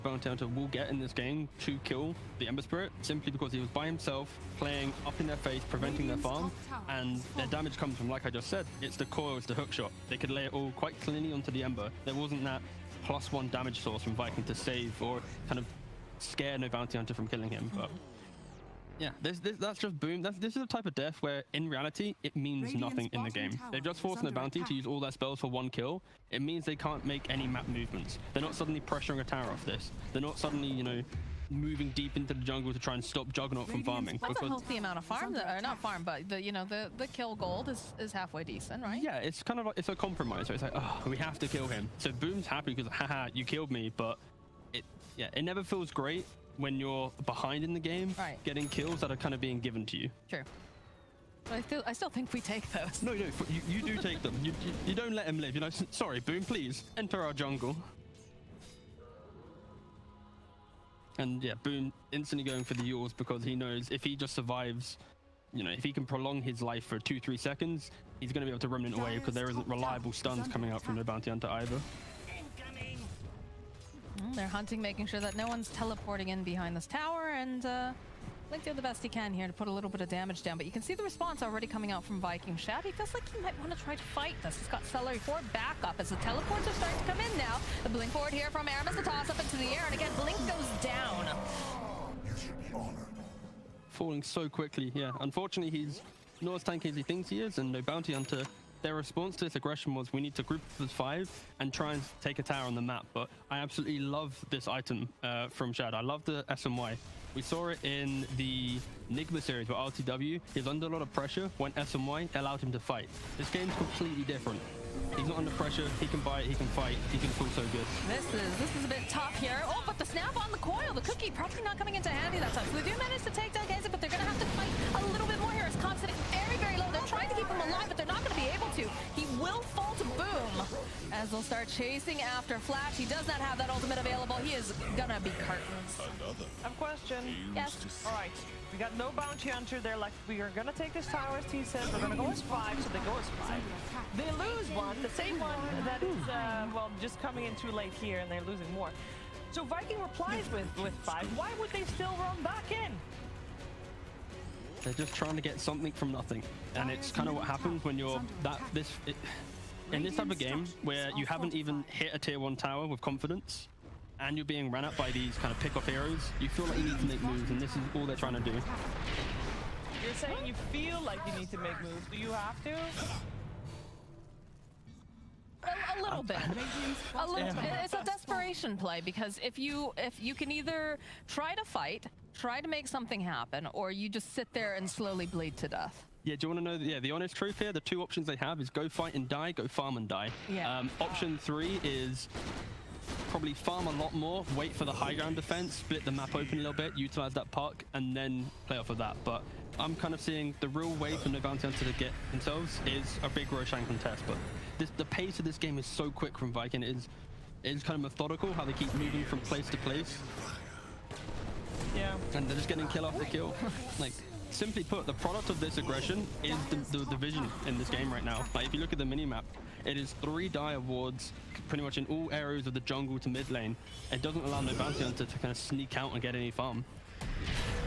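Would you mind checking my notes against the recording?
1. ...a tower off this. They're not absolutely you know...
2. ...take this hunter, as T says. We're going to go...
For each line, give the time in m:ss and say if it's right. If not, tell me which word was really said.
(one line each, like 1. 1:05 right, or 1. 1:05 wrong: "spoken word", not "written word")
1. 0:29 wrong: "suddenly", not "absolutely"
2. 2:20 wrong: "tower", not "hunter".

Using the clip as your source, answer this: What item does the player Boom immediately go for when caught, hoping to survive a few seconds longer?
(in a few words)
Eul's.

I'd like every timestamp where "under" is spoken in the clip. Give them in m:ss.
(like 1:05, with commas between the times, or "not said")
1:50, 1:55.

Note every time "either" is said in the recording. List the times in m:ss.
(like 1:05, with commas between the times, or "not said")
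1:11, 3:00.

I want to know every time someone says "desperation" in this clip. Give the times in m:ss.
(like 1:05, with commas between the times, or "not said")
2:58.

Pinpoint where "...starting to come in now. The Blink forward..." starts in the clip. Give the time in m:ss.
1:26.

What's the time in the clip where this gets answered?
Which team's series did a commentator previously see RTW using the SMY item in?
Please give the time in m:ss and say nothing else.
1:49.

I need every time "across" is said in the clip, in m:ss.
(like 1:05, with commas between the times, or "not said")
not said.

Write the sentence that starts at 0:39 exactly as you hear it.
Yeah, it's kind of like, it's a compromise.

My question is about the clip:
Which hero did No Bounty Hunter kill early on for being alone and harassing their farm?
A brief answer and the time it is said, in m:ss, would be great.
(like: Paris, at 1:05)
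Ember Spirit, at 0:02.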